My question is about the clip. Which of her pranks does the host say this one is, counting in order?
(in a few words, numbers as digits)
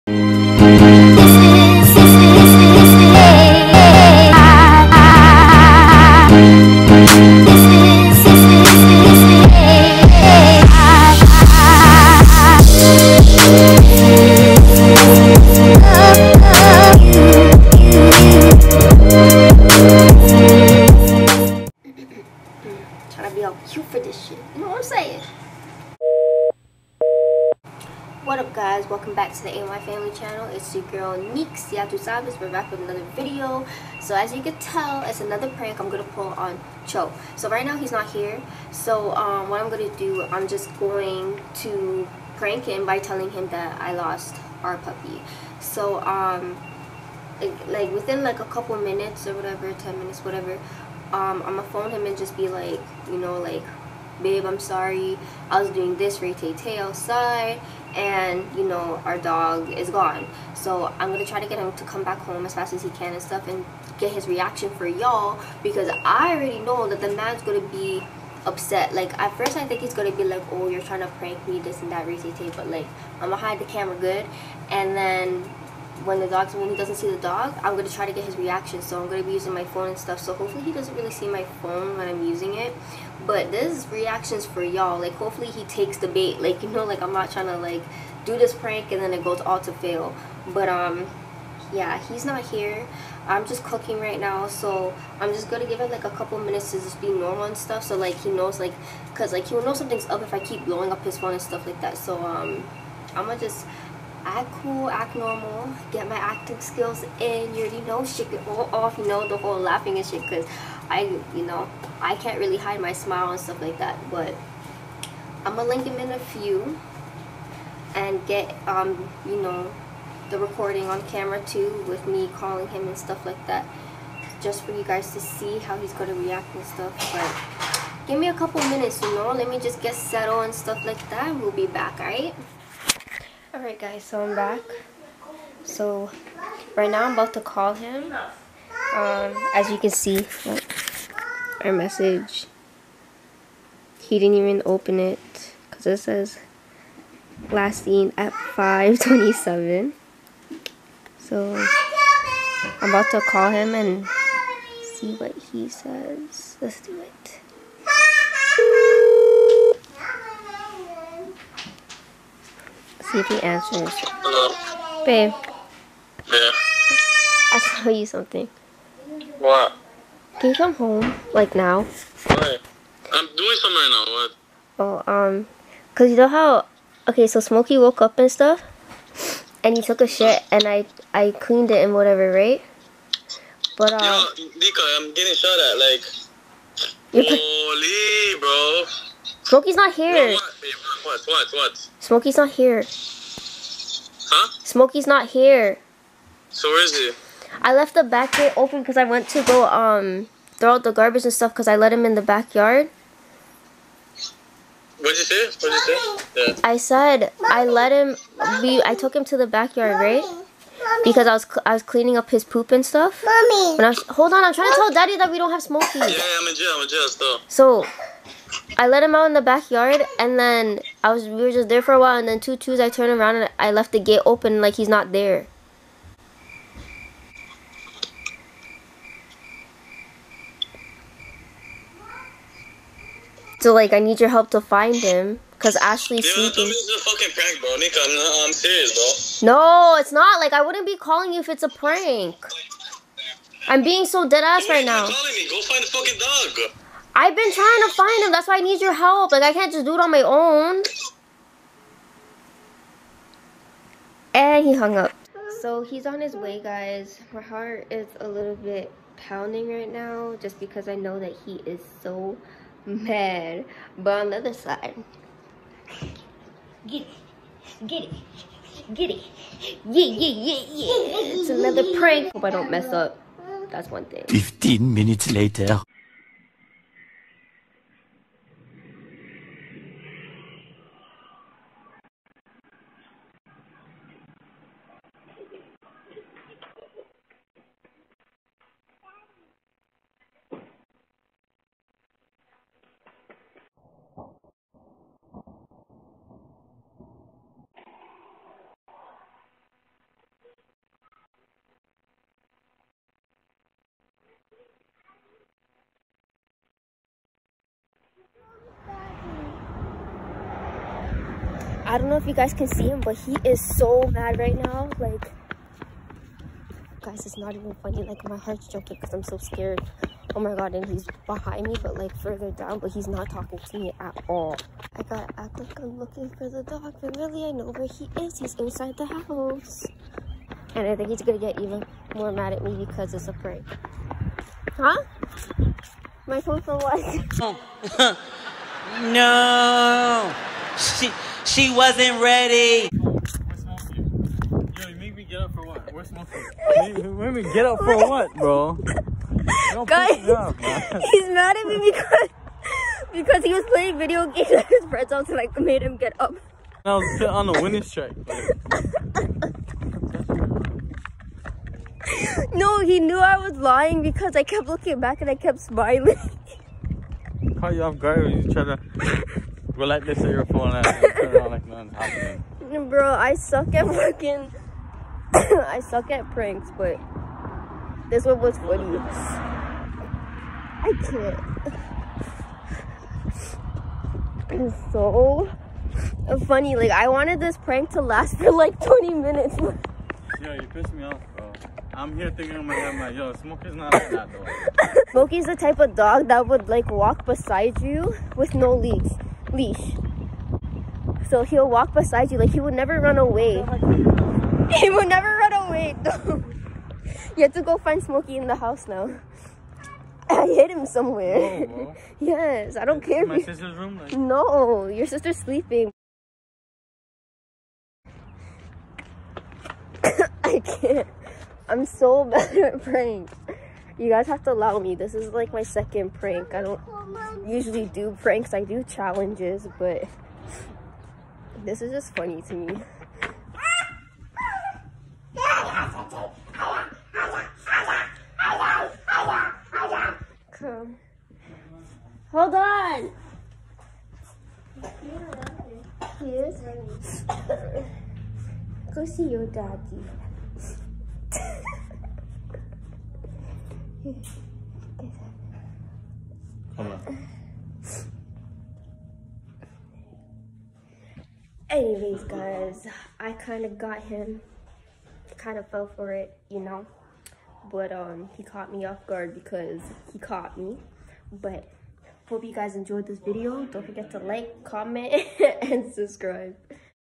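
Second.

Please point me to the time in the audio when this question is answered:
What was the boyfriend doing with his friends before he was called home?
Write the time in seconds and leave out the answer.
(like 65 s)
353 s.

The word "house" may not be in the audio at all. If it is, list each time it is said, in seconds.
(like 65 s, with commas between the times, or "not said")
329 s, 408 s.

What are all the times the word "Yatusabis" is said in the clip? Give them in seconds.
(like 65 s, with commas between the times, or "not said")
31 s.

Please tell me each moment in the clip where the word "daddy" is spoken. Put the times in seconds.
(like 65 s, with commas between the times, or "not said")
214 s, 449 s.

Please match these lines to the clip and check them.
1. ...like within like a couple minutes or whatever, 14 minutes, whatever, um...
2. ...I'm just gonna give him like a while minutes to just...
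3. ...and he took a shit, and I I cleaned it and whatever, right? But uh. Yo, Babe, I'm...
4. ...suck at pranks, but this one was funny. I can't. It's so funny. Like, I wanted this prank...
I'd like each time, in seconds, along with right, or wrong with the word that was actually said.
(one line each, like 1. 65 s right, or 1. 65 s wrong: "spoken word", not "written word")
1. 47 s wrong: "10", not "14"
2. 95 s wrong: "couple", not "while"
3. 179 s wrong: "Dika", not "Babe"
4. 375 s right.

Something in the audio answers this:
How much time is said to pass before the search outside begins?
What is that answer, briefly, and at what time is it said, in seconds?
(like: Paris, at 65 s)
15 minutes, at 274 s.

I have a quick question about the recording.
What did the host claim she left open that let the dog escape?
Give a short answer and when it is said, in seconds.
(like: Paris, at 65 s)
The back gate, at 198 s.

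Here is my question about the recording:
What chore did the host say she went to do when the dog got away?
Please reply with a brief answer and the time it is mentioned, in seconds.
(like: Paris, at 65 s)
Throw out the garbage, at 200 s.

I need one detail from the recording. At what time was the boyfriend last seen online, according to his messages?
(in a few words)
527.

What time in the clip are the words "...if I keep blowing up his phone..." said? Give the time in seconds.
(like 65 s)
100 s.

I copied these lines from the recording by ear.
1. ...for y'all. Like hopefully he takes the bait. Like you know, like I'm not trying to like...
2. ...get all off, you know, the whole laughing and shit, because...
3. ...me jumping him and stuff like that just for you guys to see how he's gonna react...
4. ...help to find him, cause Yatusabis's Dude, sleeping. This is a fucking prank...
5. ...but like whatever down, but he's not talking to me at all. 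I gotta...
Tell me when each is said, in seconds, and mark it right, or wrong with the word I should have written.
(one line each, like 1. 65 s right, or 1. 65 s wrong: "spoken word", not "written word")
1. 84 s right
2. 108 s right
3. 122 s wrong: "calling", not "jumping"
4. 234 s wrong: "Ashley", not "Yatusabis"
5. 321 s wrong: "further", not "whatever".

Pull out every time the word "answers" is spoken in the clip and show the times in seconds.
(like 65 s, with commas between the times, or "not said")
163 s.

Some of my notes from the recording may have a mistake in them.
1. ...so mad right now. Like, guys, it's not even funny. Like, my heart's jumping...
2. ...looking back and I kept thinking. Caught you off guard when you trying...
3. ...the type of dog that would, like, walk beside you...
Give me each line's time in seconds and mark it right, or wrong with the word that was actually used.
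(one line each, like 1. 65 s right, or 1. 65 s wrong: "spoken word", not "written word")
1. 313 s right
2. 364 s wrong: "smiling", not "thinking"
3. 395 s right.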